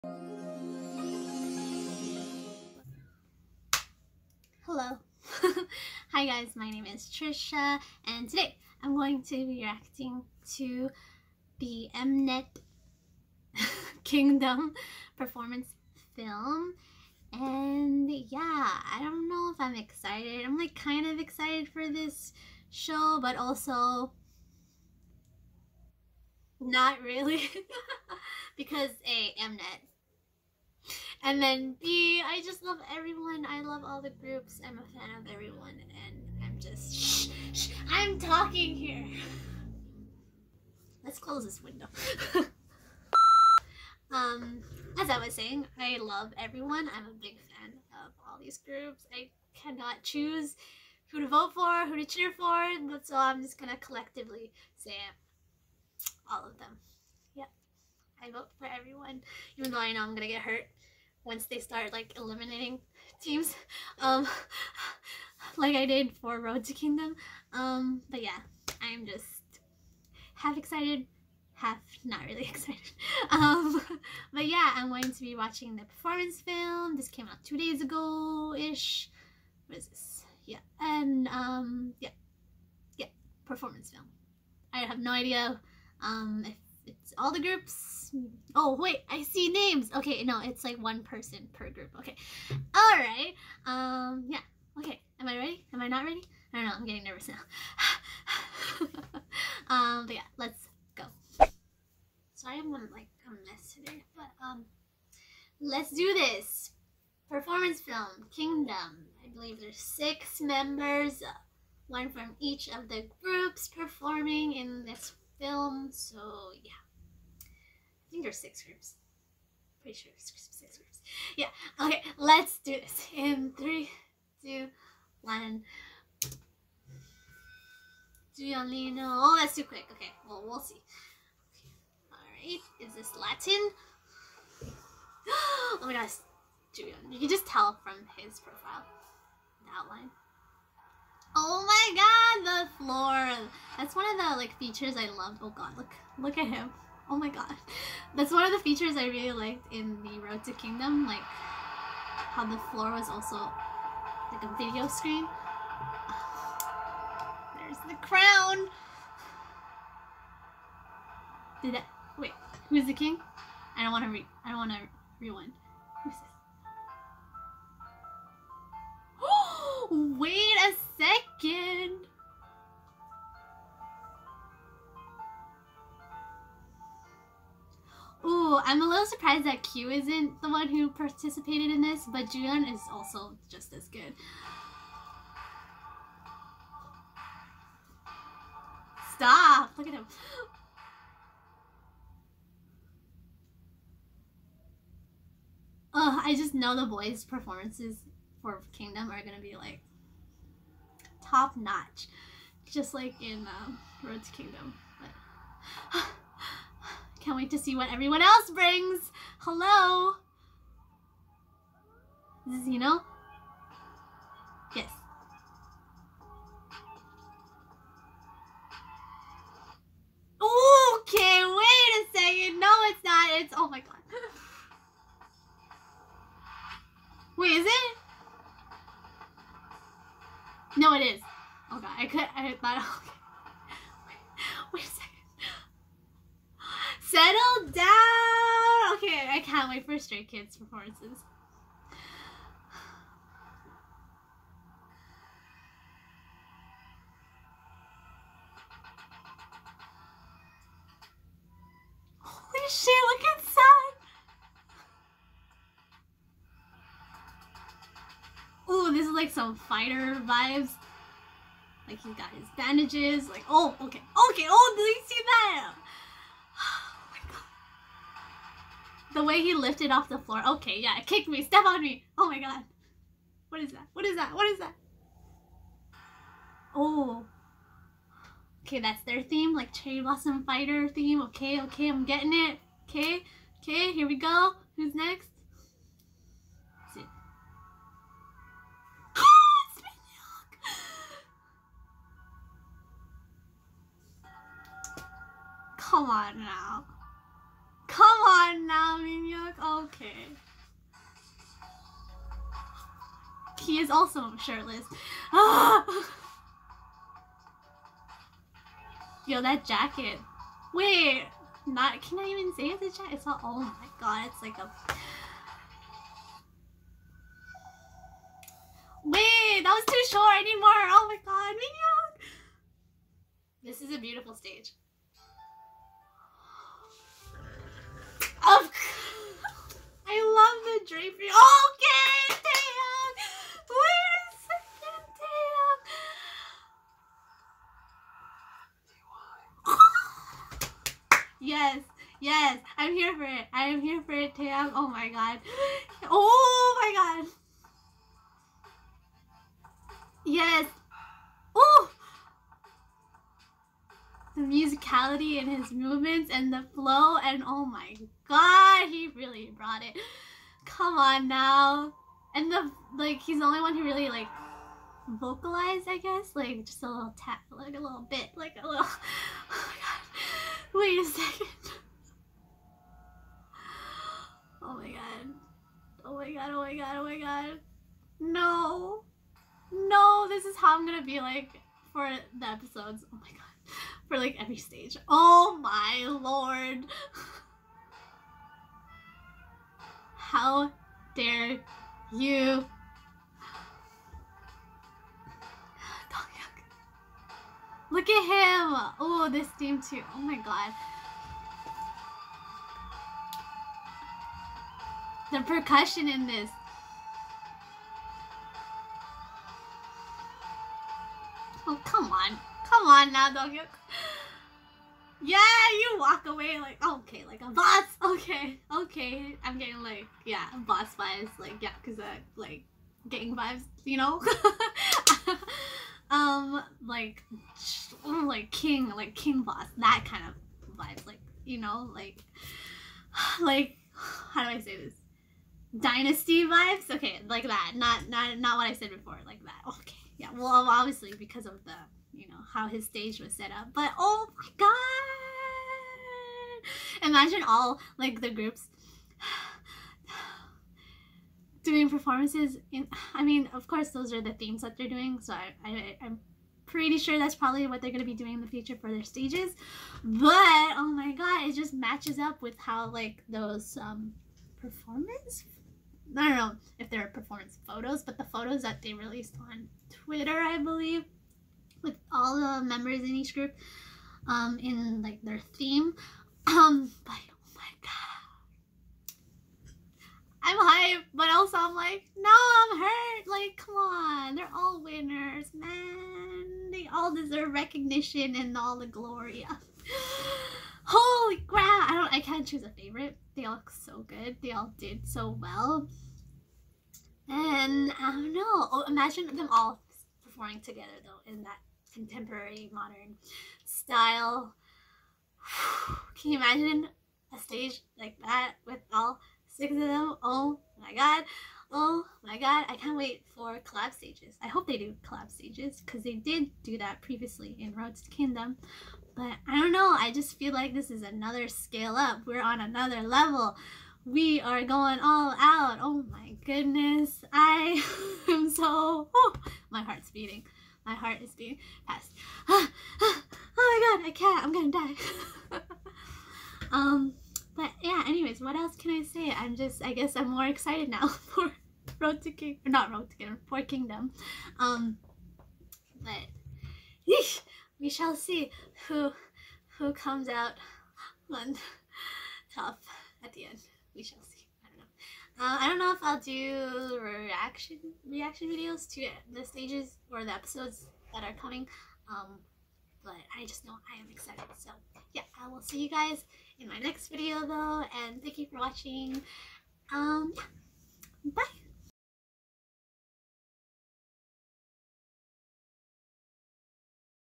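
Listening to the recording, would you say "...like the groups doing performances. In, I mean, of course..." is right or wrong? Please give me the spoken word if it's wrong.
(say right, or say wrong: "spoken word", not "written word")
right.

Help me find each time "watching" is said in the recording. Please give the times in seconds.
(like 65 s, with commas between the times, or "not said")
75 s, 568 s.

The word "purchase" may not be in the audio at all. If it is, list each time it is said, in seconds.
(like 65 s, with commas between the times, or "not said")
not said.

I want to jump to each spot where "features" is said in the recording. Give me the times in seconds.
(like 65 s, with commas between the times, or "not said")
144 s, 148 s.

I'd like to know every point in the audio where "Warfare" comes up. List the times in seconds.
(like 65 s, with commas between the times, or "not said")
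not said.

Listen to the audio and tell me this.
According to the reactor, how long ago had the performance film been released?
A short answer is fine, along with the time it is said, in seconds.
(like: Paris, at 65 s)
two days ago, at 77 s.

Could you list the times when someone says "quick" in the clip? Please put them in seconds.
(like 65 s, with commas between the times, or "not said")
129 s.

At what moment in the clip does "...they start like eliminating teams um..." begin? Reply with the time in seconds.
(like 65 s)
61 s.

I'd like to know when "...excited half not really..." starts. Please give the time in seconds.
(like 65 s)
70 s.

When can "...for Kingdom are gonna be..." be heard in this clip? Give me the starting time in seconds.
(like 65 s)
198 s.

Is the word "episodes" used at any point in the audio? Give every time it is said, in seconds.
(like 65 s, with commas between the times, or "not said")
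382 s, 560 s.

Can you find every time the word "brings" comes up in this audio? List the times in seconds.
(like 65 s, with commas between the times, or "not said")
208 s.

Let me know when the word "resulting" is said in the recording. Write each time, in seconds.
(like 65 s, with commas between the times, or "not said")
not said.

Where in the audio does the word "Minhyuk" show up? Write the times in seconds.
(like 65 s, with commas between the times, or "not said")
298 s, 321 s.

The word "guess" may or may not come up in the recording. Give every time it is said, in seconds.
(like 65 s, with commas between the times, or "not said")
366 s, 539 s.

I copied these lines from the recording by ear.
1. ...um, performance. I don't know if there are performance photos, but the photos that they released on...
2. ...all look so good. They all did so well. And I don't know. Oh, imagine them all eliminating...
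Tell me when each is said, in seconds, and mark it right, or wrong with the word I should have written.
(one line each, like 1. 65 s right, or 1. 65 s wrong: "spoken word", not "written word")
1. 463 s right
2. 493 s wrong: "performing", not "eliminating".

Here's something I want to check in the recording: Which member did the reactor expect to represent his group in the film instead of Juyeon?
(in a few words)
Q.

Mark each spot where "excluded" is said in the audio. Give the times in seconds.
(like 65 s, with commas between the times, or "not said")
not said.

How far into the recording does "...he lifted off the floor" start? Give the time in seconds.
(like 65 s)
269 s.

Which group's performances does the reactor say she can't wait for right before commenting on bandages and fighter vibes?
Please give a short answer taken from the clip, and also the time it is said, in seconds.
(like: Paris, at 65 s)
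Stray Kids, at 239 s.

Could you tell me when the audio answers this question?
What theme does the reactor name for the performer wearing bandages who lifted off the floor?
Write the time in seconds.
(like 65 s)
279 s.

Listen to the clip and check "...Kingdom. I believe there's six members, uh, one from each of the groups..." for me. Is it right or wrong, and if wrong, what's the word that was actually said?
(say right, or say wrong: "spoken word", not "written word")
right.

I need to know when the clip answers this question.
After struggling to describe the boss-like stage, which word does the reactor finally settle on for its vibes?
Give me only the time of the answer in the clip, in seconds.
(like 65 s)
435 s.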